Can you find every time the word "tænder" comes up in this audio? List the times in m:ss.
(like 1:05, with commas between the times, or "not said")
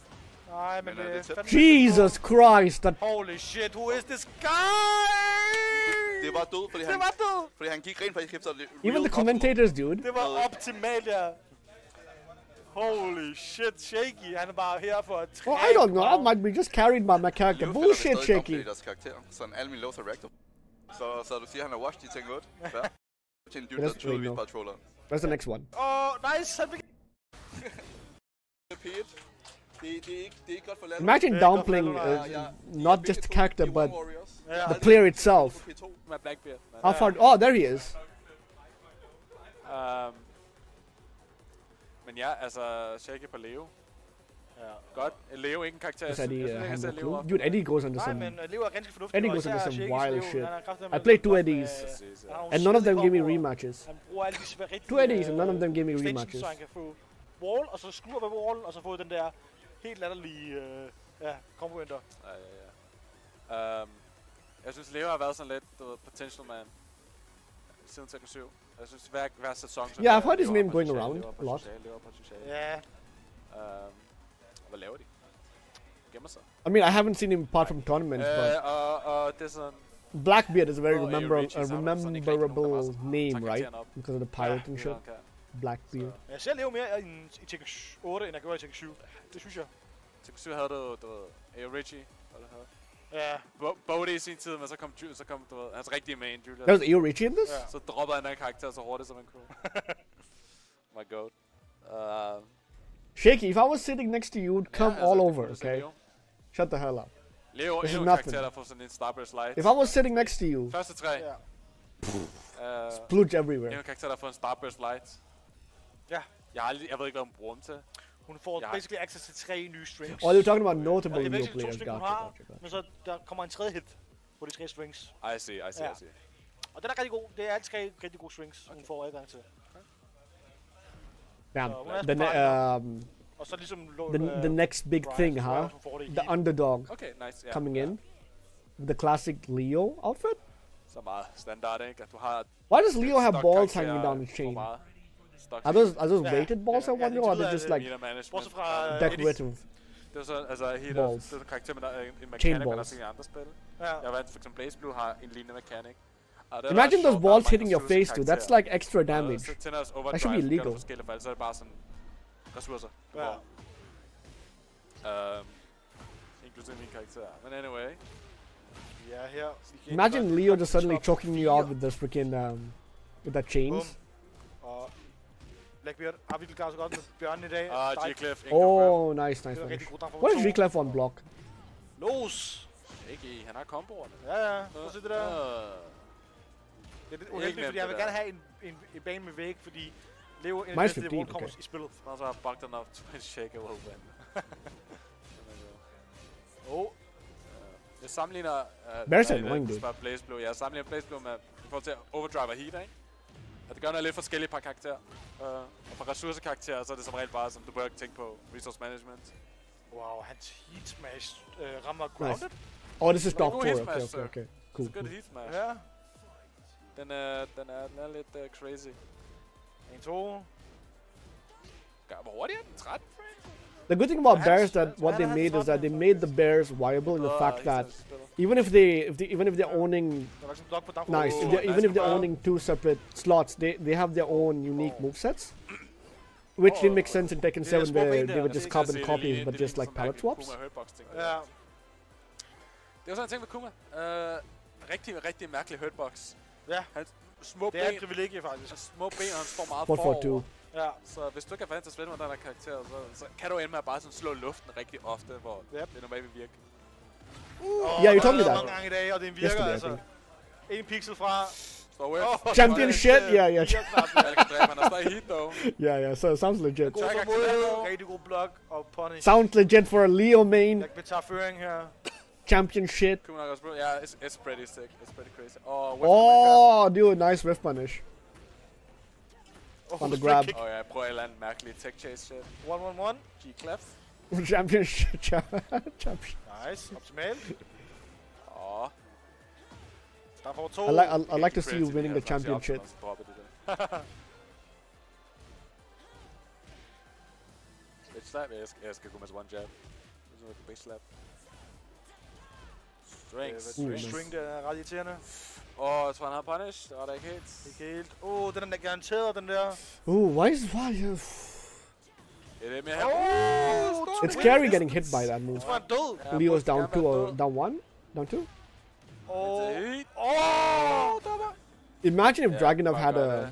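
2:39.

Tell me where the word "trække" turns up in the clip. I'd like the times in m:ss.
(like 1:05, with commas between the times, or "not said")
0:15.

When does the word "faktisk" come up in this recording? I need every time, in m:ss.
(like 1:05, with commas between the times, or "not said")
0:08, 4:08.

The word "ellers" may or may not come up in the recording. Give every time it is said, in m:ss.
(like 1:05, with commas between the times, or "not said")
2:41, 4:41.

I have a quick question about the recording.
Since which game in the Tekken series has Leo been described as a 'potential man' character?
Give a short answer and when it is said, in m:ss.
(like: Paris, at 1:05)
Tekken 7, at 1:07.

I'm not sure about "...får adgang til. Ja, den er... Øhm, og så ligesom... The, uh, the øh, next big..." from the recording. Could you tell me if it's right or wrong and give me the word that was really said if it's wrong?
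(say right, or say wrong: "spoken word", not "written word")
right.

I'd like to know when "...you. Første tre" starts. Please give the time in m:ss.
1:50.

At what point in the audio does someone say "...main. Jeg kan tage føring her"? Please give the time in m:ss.
4:30.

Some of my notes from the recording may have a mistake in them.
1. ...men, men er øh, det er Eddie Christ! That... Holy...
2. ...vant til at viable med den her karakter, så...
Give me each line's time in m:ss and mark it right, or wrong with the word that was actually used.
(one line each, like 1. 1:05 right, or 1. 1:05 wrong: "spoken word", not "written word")
1. 0:00 wrong: "Jesus", not "Eddie"
2. 4:11 wrong: "spille", not "viable".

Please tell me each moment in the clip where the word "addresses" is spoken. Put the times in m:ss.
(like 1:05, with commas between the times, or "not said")
not said.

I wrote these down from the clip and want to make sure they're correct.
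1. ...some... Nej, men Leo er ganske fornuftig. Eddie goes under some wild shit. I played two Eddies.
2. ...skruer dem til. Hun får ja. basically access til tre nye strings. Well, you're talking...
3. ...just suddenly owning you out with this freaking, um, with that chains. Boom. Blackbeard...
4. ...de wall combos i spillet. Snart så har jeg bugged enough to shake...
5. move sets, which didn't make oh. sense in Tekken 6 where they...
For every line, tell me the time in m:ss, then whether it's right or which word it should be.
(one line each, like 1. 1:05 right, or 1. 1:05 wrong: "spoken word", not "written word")
1. 0:48 right
2. 1:57 wrong: "bruger", not "skruer"
3. 2:50 wrong: "choking", not "owning"
4. 3:10 right
5. 3:55 wrong: "7", not "6".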